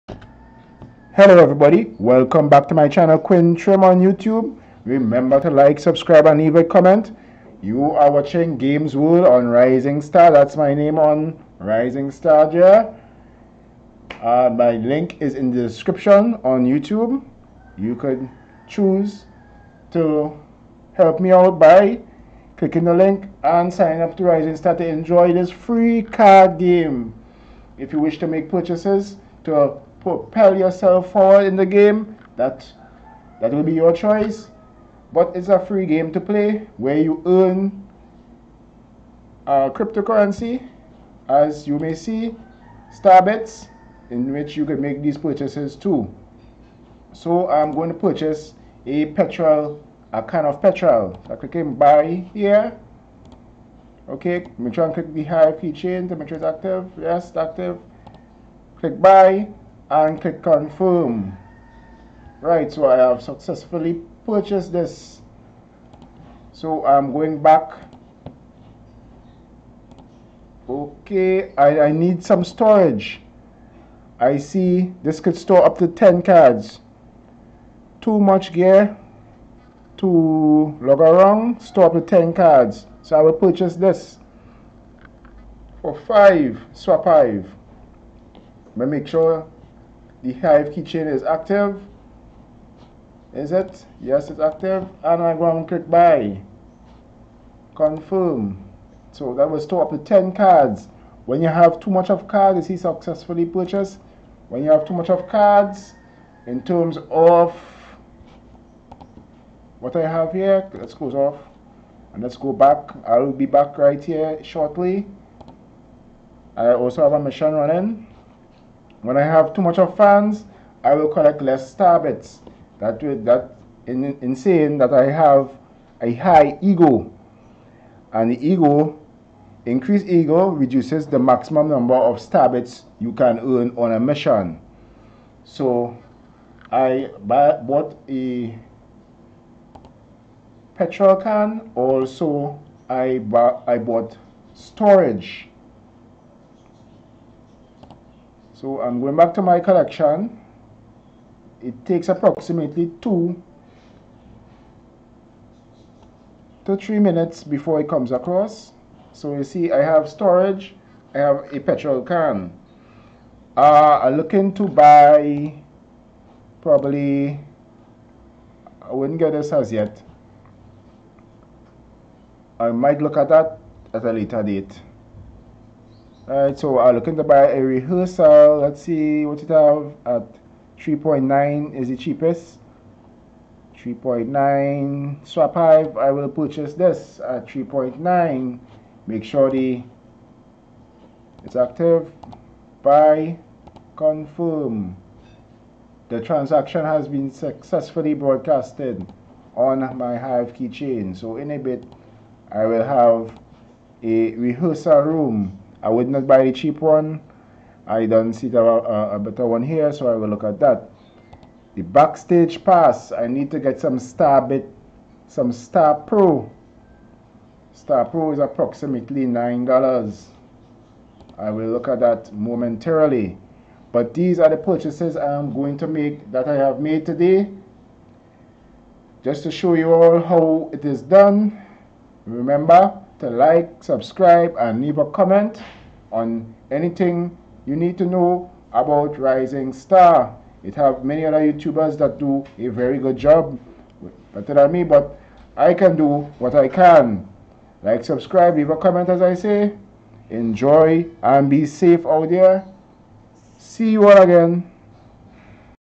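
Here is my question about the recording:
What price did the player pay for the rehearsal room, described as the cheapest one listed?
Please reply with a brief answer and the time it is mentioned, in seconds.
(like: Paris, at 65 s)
3.9 SWAP.HIVE, at 183 s.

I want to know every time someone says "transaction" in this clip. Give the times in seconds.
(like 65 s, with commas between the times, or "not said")
196 s.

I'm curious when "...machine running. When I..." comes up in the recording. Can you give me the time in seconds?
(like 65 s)
117 s.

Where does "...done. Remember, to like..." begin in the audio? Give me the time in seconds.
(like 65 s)
231 s.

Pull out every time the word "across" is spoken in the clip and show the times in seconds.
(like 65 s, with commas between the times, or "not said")
158 s.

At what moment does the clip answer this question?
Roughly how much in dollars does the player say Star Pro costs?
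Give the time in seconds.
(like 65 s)
219 s.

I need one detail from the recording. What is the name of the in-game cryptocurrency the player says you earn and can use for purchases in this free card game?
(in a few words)
Starbits.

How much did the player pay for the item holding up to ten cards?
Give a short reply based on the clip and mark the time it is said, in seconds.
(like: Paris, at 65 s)
5 SWAP.HIVE, at 86 s.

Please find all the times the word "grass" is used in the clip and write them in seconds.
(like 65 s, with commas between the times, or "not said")
not said.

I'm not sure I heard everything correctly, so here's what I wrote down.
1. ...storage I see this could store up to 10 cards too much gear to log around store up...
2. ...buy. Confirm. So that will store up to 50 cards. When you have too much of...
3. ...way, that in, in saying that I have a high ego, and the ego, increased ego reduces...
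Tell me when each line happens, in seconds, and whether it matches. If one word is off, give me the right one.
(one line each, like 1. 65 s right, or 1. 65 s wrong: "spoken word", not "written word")
1. 72 s right
2. 95 s wrong: "10", not "50"
3. 123 s right.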